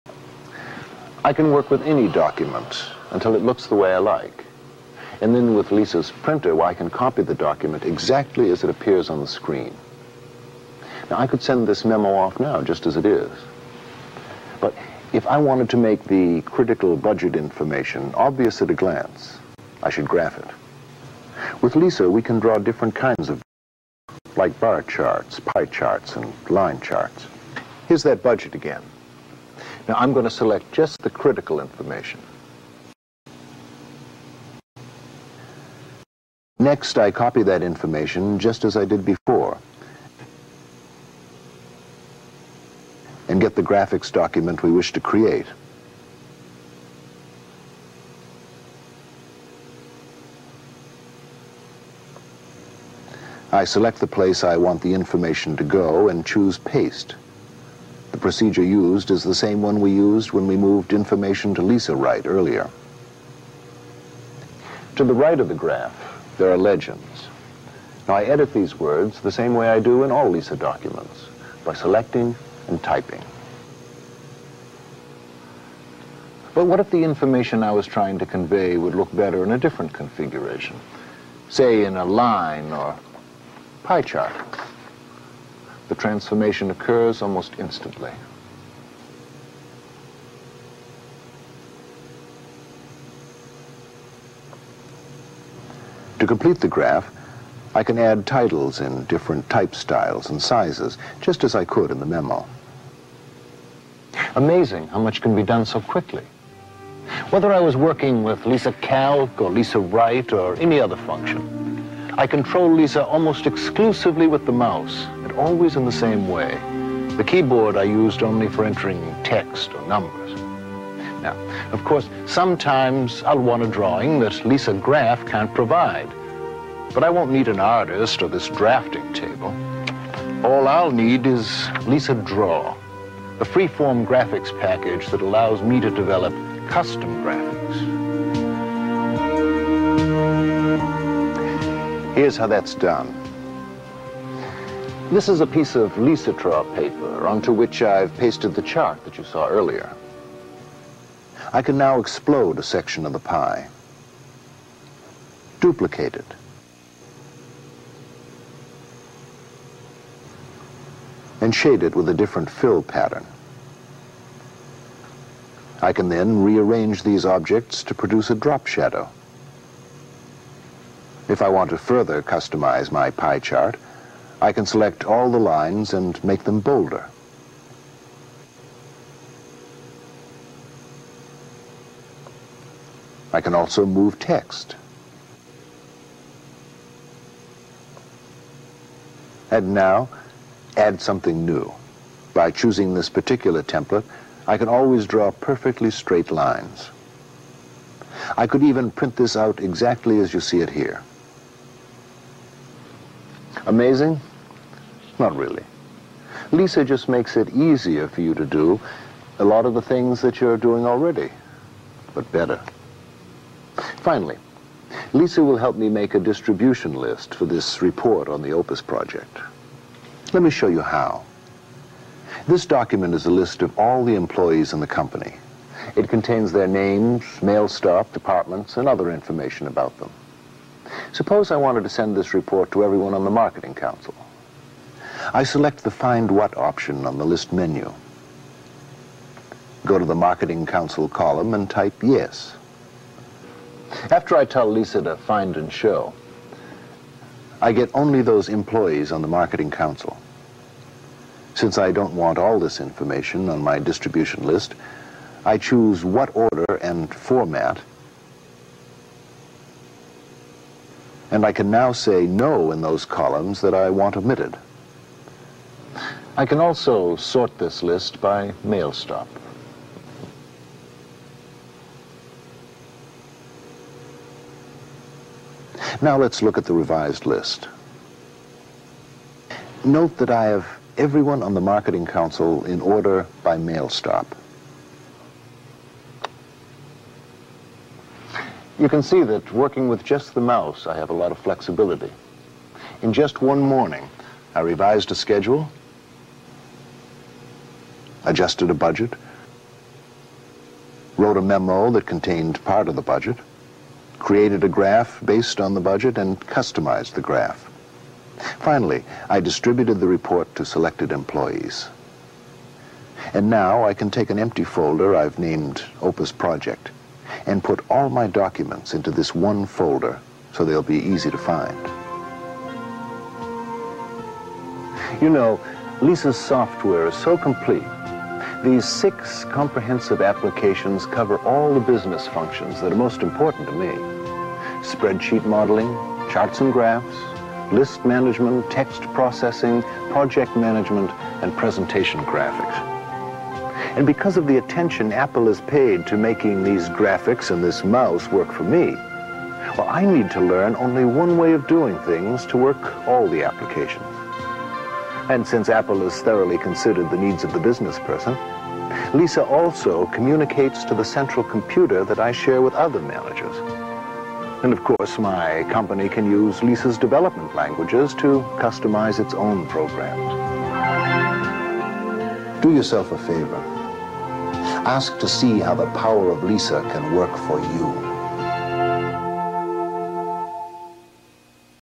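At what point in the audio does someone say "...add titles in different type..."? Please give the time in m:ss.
1:37.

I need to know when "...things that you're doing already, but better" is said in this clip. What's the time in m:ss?
3:29.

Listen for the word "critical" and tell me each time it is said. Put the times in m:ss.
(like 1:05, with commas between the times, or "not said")
0:16, 0:31.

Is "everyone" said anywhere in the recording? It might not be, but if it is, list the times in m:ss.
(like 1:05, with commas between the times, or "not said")
3:52, 4:40.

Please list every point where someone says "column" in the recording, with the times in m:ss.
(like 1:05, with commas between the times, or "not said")
4:01, 4:23.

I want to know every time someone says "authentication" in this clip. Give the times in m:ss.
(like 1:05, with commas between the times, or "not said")
not said.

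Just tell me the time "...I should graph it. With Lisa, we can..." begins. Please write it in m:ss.
0:19.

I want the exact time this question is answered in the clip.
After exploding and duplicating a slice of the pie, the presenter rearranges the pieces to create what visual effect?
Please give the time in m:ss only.
2:48.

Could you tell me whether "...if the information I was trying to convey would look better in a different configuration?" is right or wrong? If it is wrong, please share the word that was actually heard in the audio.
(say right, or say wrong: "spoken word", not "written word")
right.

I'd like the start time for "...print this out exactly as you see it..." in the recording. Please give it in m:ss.
3:18.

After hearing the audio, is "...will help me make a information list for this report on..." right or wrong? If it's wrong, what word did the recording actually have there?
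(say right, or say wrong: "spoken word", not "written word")
wrong: "distribution", not "information".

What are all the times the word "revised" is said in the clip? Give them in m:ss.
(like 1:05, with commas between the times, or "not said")
4:36, 4:54.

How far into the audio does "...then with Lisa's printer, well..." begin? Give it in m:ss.
0:05.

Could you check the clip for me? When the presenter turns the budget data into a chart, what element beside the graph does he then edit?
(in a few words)
legends.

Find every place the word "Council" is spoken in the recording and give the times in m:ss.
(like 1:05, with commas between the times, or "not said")
3:53, 4:00, 4:09, 4:42.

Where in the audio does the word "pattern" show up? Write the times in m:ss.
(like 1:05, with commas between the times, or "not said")
2:42.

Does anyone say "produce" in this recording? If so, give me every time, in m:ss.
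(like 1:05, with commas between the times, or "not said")
2:47.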